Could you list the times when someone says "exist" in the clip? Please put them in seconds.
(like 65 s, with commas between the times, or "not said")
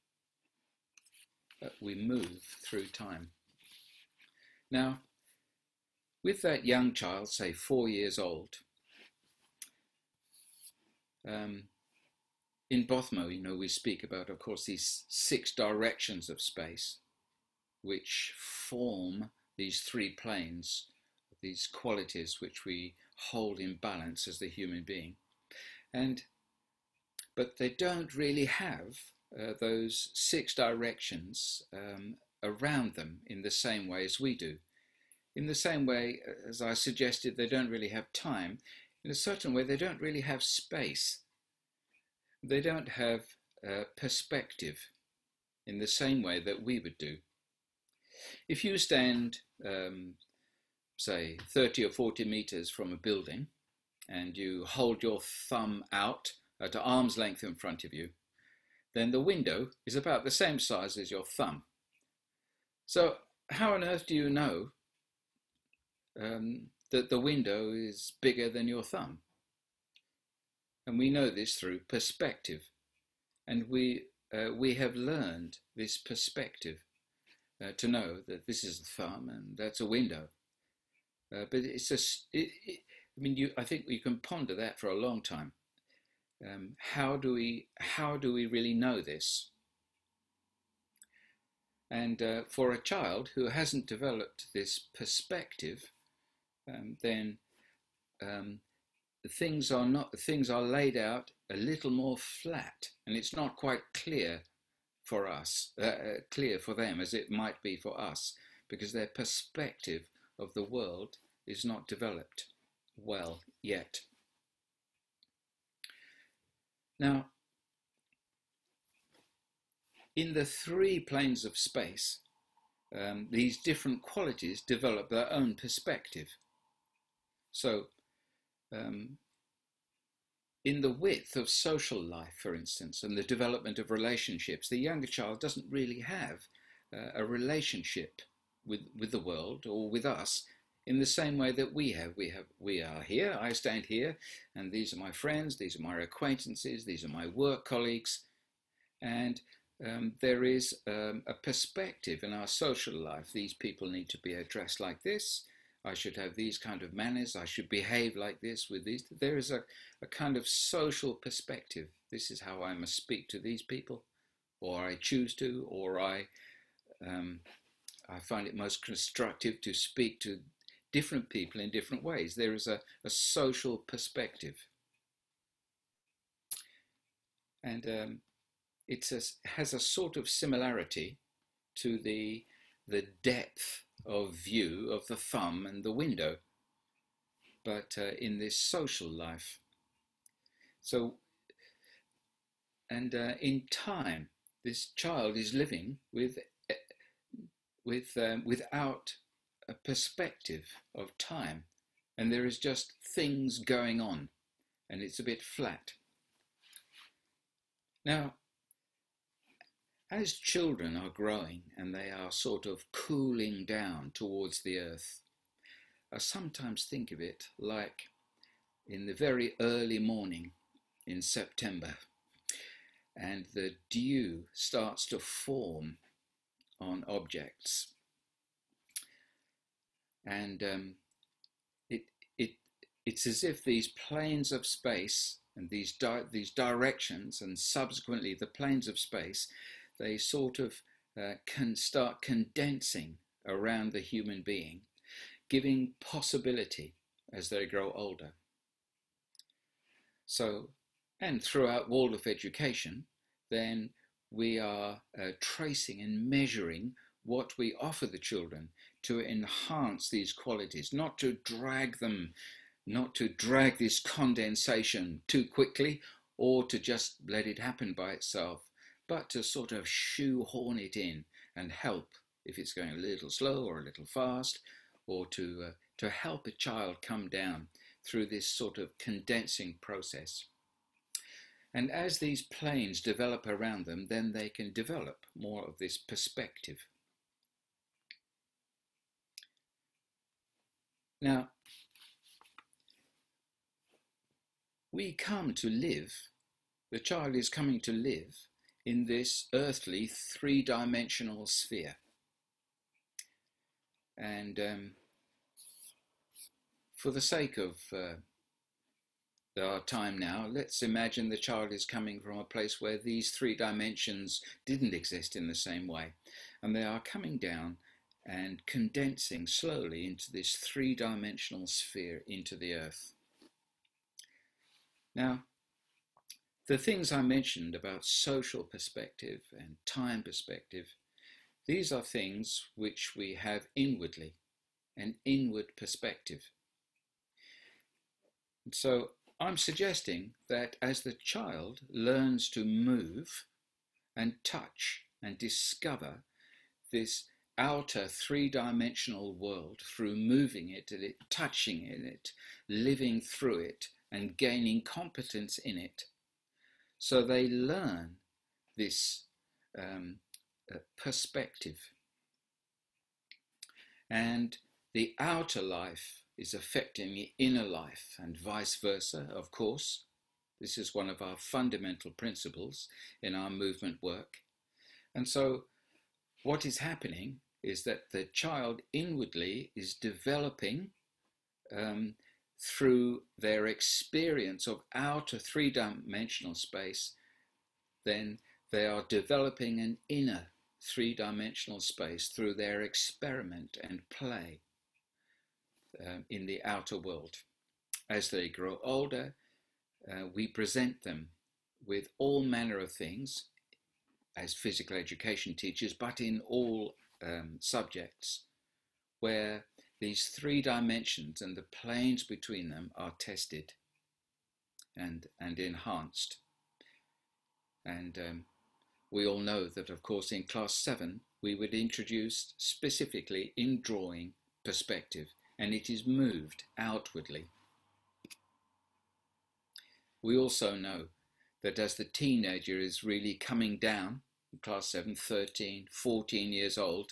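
314 s.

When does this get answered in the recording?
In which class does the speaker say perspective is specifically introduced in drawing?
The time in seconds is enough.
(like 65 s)
420 s.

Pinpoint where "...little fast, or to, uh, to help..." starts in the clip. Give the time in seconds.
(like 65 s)
273 s.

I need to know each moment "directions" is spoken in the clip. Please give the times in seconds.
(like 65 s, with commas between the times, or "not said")
15 s, 30 s, 236 s.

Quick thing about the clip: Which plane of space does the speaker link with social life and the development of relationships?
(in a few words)
The width.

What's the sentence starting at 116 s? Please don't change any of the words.
Now, in the three planes of space, um, these different qualities develop their own perspective.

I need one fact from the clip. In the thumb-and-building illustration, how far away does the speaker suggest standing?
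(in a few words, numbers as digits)
30 or 40 meters.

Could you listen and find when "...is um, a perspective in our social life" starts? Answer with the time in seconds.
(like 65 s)
150 s.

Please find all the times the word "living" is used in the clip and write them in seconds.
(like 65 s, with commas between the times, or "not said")
195 s, 352 s.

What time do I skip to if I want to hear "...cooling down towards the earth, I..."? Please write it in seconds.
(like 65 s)
212 s.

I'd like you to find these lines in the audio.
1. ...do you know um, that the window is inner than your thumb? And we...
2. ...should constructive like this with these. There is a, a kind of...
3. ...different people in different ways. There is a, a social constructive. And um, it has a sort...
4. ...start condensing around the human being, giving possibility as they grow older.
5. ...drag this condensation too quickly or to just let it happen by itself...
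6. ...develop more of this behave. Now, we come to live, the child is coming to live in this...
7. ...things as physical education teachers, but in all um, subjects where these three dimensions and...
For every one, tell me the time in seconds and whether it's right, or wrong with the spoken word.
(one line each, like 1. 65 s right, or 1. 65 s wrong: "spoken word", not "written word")
1. 64 s wrong: "bigger", not "inner"
2. 157 s wrong: "behave", not "constructive"
3. 170 s wrong: "perspective", not "constructive"
4. 241 s right
5. 263 s right
6. 284 s wrong: "perspective", not "behave"
7. 402 s right.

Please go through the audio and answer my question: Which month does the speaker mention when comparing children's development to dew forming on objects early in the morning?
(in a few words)
September.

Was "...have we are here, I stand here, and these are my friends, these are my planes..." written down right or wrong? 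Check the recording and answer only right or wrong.
wrong.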